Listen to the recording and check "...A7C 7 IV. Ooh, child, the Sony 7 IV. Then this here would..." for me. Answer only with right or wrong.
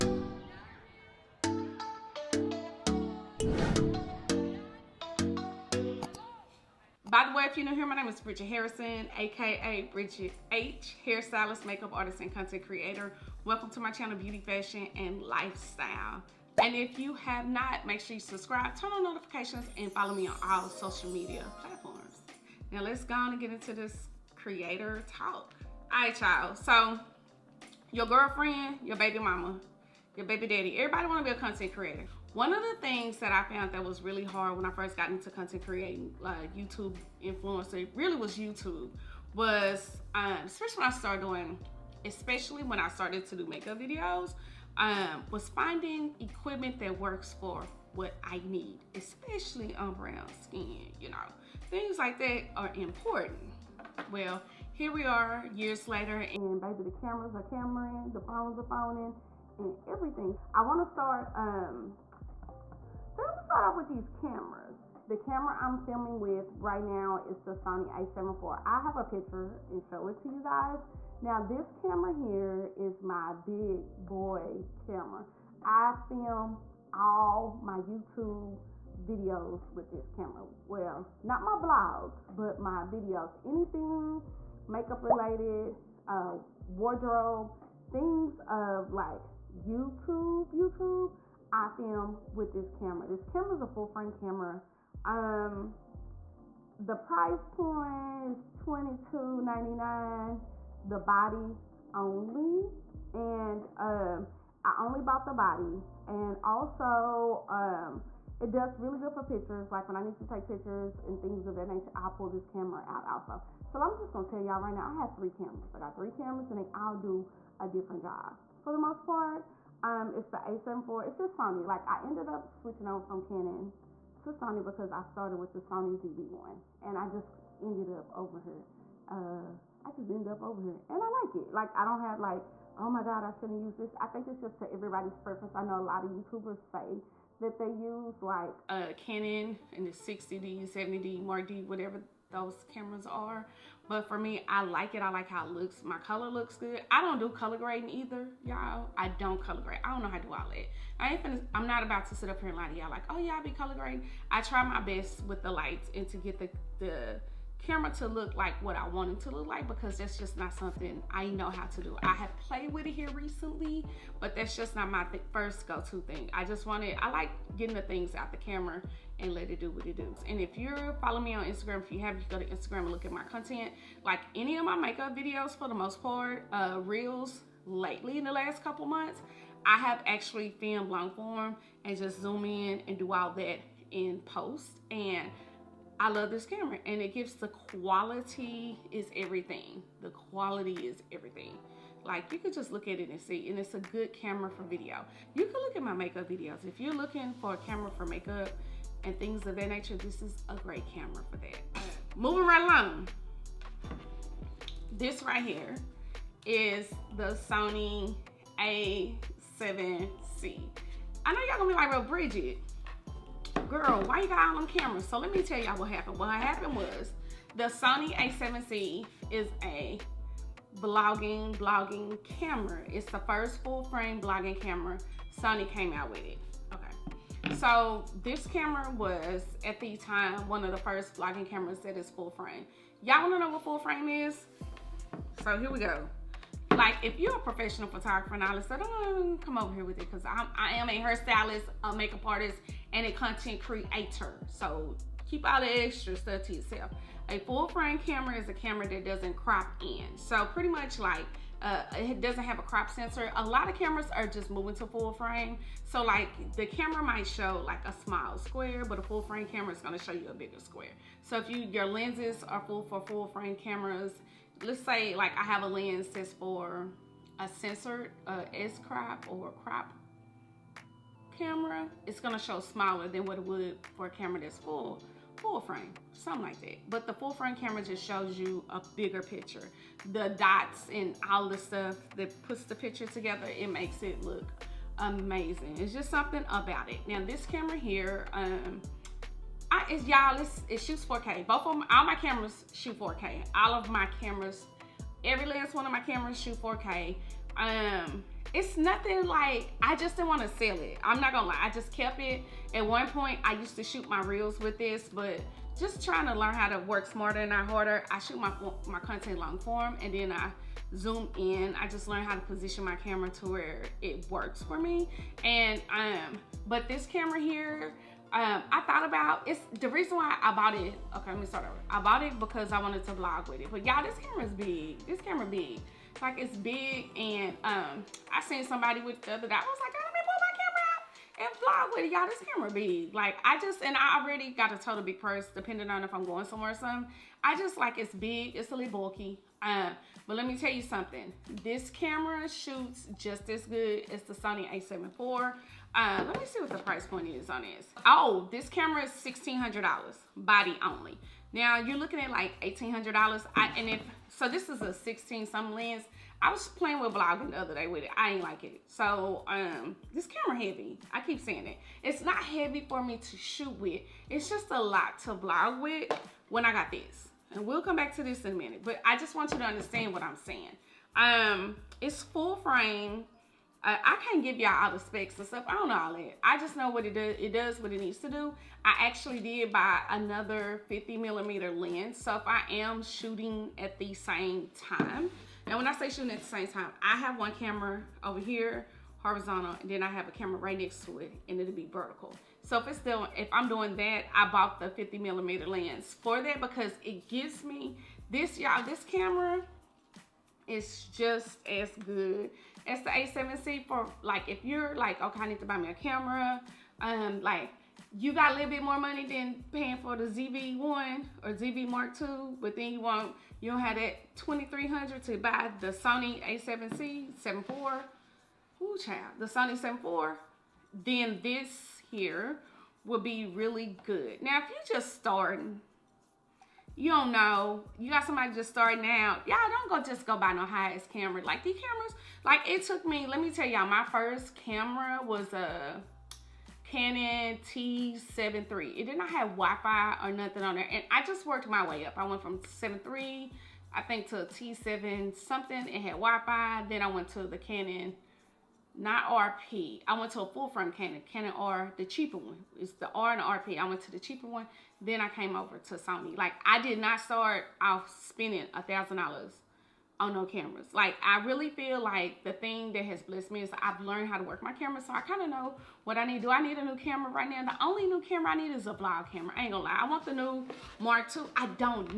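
right.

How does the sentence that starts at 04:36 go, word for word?
But the full frame camera just shows you a bigger picture.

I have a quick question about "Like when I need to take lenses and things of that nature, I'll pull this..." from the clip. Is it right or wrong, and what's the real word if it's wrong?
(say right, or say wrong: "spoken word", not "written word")
wrong: "pictures", not "lenses".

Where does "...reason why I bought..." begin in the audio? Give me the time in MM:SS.
05:19.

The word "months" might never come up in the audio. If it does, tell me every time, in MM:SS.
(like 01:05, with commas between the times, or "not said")
02:58.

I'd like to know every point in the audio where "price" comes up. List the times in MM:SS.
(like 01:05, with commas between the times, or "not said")
01:36, 05:46.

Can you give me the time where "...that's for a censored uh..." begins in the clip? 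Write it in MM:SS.
04:26.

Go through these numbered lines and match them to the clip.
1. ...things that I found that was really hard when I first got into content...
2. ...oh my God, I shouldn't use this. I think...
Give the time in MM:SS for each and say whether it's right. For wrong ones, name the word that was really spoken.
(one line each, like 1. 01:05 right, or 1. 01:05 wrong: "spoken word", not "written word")
1. 00:32 right
2. 02:12 right.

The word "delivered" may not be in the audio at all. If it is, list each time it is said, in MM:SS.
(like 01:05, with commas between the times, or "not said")
not said.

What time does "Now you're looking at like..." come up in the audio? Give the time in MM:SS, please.
05:51.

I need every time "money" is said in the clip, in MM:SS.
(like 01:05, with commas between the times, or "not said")
06:48.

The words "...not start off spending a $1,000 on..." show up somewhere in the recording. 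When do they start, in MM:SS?
07:36.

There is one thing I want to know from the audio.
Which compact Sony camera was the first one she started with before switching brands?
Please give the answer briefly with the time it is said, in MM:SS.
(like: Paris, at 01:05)
Sony ZV-1, at 02:05.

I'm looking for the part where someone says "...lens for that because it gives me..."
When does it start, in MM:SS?
06:35.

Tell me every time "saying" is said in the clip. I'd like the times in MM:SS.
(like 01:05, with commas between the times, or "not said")
06:01, 06:10.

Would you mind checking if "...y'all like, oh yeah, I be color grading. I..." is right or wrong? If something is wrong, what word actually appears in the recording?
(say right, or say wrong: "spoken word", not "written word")
right.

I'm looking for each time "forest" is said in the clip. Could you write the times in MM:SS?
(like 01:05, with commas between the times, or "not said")
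not said.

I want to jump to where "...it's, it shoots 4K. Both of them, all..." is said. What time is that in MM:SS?
04:50.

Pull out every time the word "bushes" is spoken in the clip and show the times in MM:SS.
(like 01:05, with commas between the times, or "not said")
not said.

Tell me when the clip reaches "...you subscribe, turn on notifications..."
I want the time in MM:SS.
00:18.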